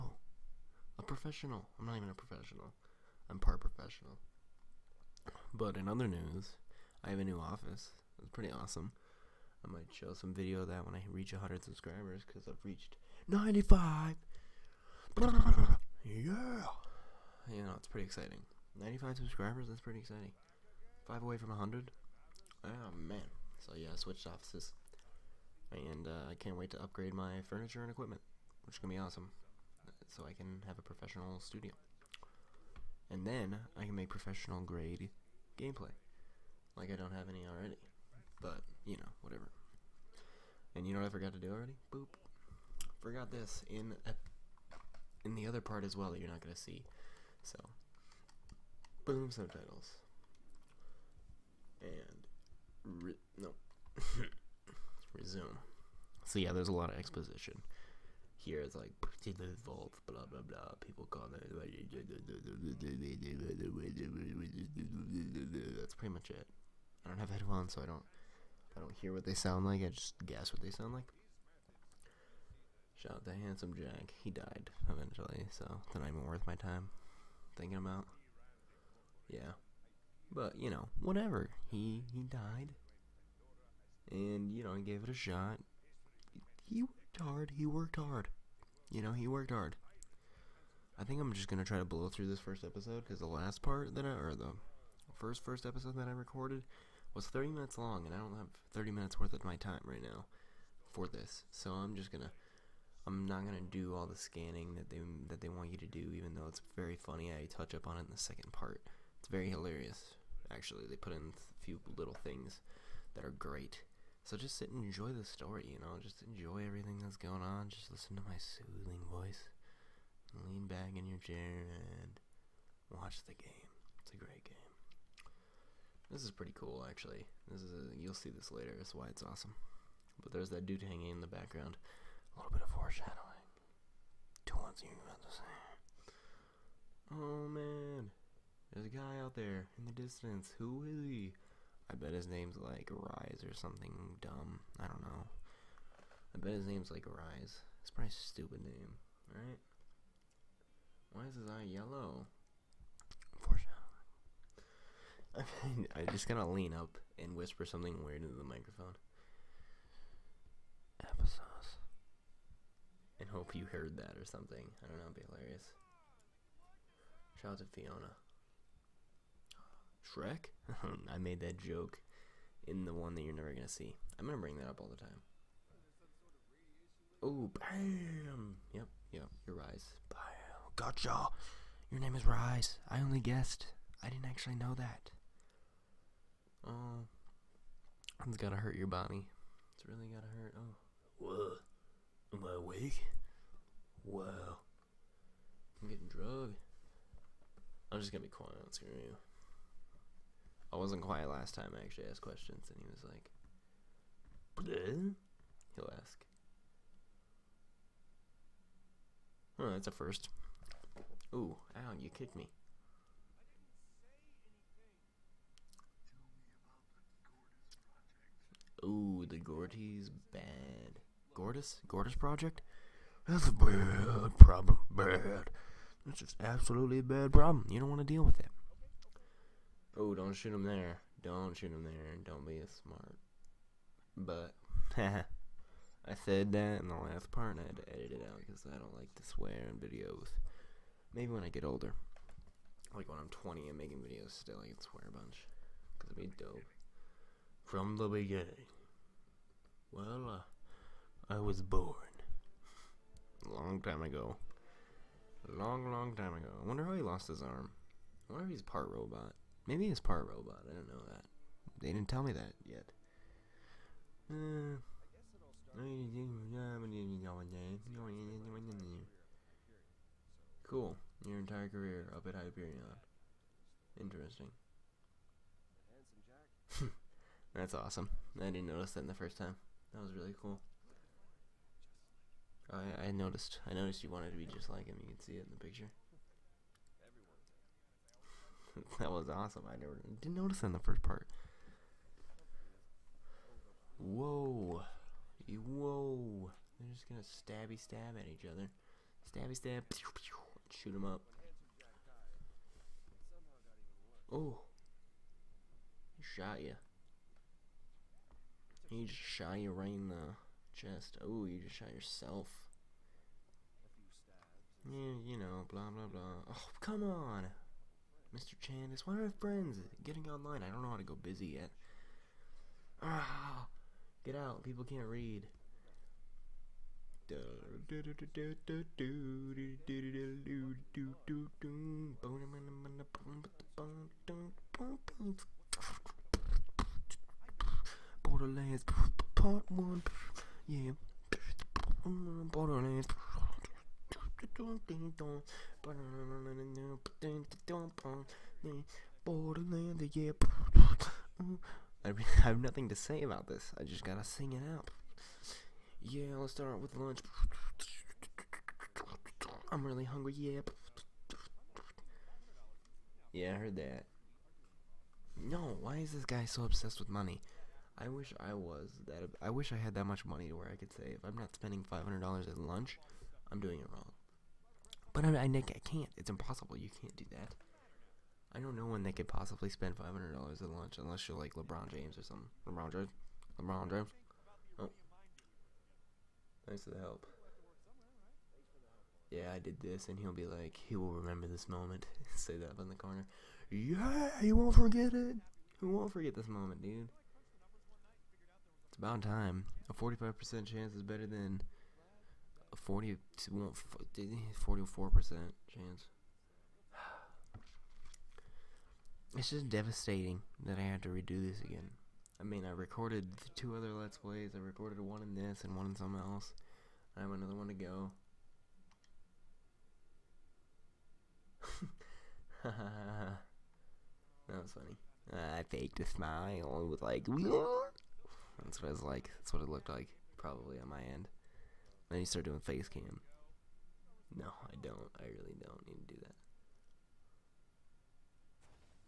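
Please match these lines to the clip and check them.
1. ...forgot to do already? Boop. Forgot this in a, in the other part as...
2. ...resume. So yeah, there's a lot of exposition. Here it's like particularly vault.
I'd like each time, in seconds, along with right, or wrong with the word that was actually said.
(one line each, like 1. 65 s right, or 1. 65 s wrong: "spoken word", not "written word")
1. 41 s right
2. 55 s right.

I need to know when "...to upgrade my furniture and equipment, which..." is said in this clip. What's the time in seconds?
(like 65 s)
26 s.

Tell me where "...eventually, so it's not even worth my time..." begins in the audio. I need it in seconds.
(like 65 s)
74 s.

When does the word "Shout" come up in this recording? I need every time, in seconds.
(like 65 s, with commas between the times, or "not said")
73 s, 167 s.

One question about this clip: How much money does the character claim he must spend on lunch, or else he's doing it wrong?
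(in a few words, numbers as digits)
$500.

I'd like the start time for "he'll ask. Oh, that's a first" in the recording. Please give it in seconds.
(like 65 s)
205 s.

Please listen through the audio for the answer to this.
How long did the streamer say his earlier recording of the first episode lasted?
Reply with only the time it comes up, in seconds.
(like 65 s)
97 s.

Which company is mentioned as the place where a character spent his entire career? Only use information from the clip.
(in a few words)
Hyperion.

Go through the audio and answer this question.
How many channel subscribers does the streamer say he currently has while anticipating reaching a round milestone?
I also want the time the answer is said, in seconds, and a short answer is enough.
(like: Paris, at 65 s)
95, at 12 s.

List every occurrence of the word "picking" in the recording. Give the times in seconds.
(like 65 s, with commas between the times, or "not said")
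not said.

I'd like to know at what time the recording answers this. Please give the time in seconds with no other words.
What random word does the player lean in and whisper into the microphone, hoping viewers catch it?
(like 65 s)
161 s.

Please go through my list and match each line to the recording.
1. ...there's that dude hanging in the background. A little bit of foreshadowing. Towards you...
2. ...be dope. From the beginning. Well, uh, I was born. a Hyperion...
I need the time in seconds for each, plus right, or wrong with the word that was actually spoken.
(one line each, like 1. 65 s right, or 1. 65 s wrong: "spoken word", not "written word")
1. 130 s right
2. 246 s wrong: "Long", not "Hyperion".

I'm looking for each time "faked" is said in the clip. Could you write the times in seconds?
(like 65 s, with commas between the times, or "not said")
425 s.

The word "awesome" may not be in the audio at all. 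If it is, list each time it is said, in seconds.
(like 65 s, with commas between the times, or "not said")
8 s, 29 s, 129 s, 277 s, 289 s.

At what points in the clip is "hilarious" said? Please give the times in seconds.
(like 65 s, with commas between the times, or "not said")
109 s, 165 s.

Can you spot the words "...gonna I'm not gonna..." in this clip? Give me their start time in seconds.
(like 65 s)
102 s.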